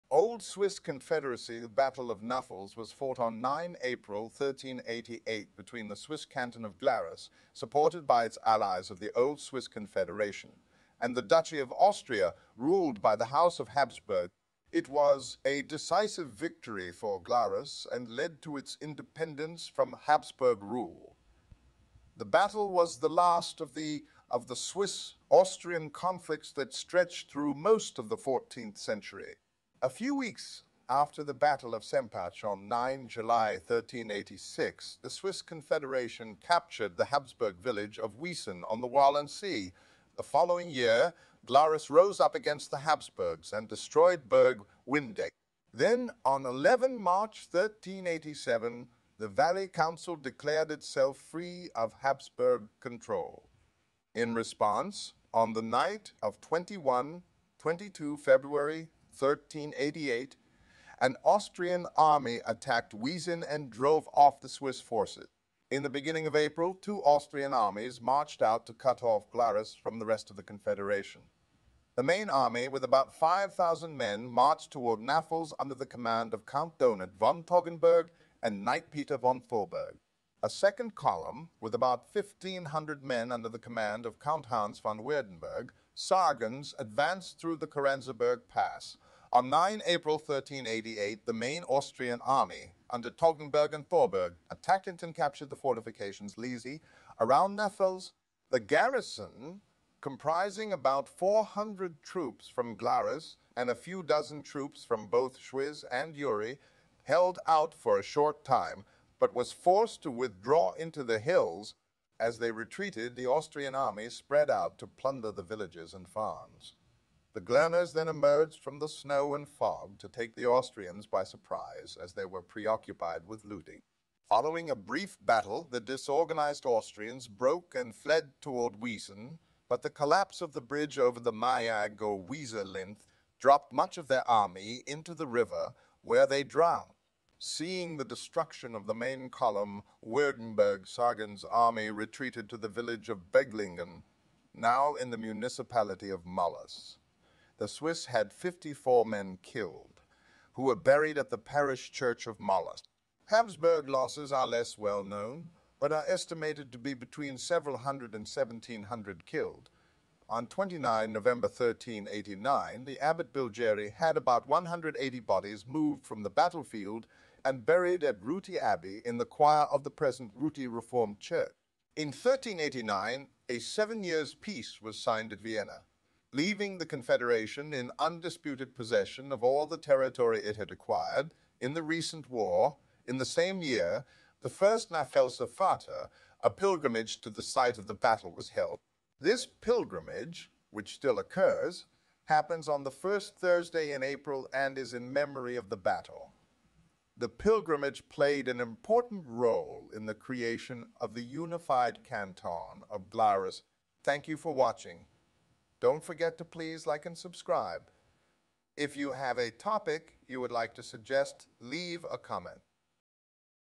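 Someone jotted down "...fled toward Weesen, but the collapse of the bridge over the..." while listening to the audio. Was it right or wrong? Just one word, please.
right.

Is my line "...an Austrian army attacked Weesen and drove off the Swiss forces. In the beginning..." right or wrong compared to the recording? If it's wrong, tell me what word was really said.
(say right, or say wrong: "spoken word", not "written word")
right.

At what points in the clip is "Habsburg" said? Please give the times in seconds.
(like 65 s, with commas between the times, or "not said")
13 s, 20 s, 37 s, 42 s, 52 s, 153 s.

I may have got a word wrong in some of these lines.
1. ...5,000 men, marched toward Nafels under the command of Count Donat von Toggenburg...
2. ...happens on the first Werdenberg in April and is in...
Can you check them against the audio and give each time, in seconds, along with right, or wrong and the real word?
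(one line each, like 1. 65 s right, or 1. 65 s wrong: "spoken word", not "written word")
1. 73 s right
2. 192 s wrong: "Thursday", not "Werdenberg".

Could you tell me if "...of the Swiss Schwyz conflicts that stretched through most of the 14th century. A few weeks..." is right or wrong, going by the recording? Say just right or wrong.
wrong.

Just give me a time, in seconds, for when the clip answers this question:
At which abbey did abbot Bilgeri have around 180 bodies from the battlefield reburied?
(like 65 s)
168 s.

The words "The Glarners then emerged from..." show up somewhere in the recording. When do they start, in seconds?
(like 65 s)
117 s.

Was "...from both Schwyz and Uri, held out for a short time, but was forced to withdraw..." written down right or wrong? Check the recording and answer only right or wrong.
right.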